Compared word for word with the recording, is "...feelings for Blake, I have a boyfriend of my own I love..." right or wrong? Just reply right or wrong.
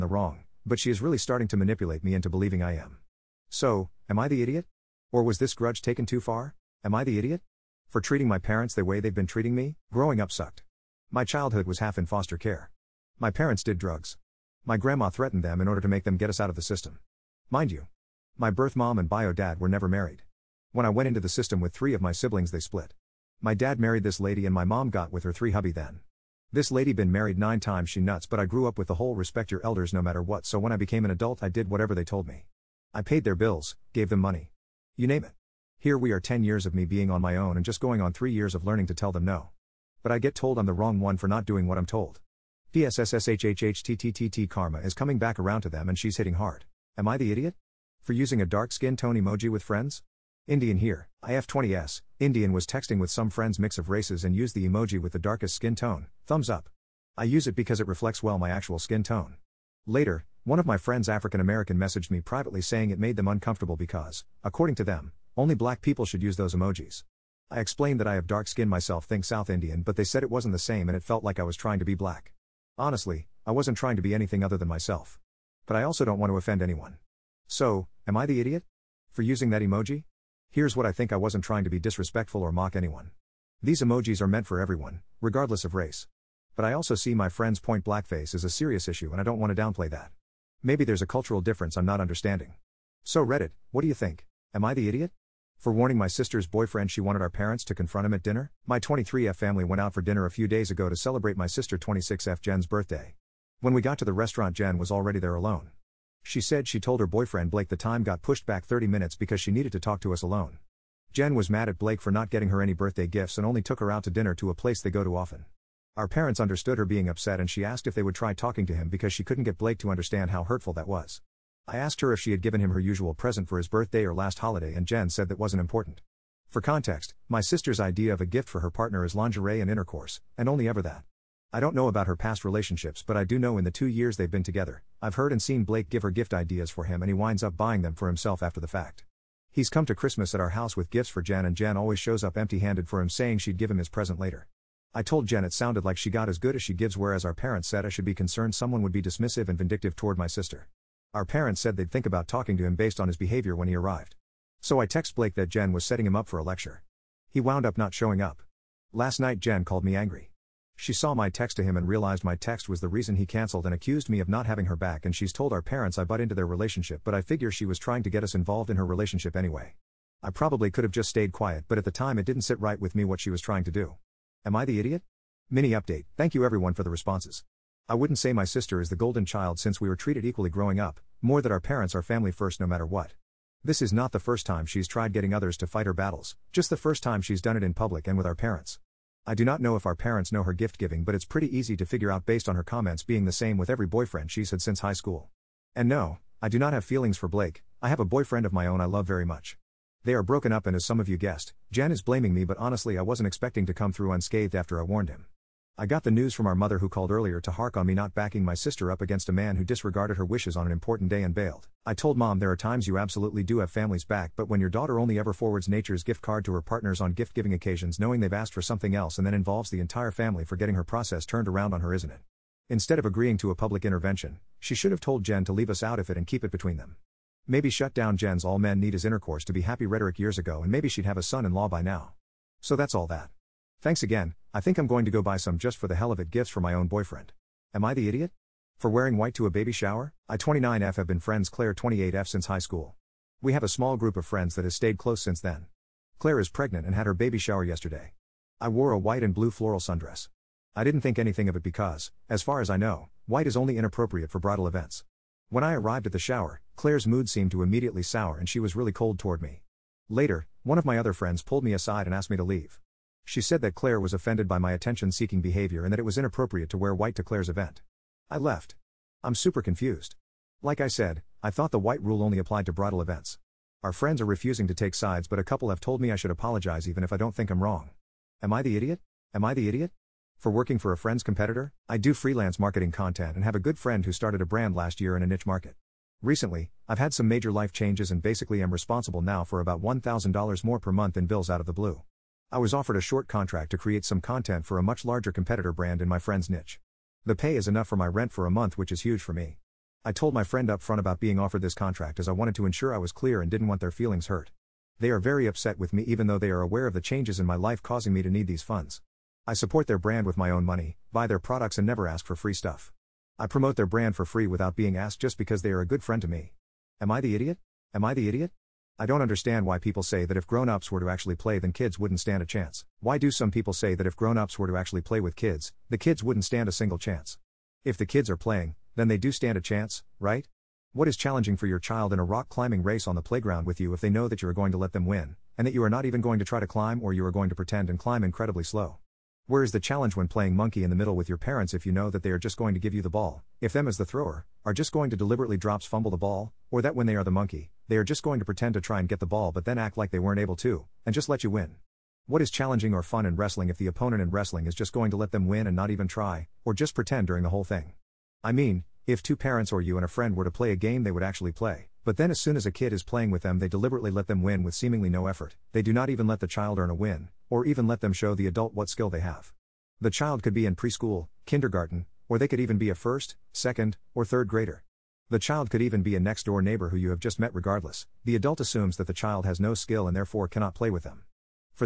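right.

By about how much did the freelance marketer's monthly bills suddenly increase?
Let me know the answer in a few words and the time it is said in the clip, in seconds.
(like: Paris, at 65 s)
$1,000, at 289 s.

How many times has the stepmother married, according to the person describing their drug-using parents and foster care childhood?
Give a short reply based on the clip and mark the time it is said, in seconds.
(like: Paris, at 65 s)
9, at 27 s.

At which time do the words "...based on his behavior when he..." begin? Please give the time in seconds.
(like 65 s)
152 s.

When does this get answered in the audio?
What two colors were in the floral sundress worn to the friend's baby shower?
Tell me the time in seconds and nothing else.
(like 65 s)
248 s.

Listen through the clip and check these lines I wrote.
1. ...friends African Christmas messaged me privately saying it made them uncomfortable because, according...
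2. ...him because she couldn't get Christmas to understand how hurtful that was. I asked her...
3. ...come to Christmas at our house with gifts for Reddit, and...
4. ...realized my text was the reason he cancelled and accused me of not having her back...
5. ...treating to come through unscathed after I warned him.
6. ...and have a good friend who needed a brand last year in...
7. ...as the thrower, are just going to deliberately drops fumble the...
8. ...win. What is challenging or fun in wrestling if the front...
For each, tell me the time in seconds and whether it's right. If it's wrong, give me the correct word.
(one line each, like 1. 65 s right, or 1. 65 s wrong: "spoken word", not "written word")
1. 60 s wrong: "American", not "Christmas"
2. 118 s wrong: "Blake", not "Christmas"
3. 139 s wrong: "Jan", not "Reddit"
4. 161 s right
5. 203 s wrong: "expecting", not "treating"
6. 283 s wrong: "started", not "needed"
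7. 343 s right
8. 351 s wrong: "opponent", not "front".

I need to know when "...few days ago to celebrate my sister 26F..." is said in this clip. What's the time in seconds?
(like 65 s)
100 s.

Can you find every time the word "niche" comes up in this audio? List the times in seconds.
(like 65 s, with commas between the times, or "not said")
285 s, 296 s.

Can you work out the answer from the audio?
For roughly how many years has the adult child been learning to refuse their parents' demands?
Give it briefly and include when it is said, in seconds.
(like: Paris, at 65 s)
3 years, at 38 s.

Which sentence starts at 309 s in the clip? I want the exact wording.
I support their brand with my own money, buy their products and never ask for free stuff.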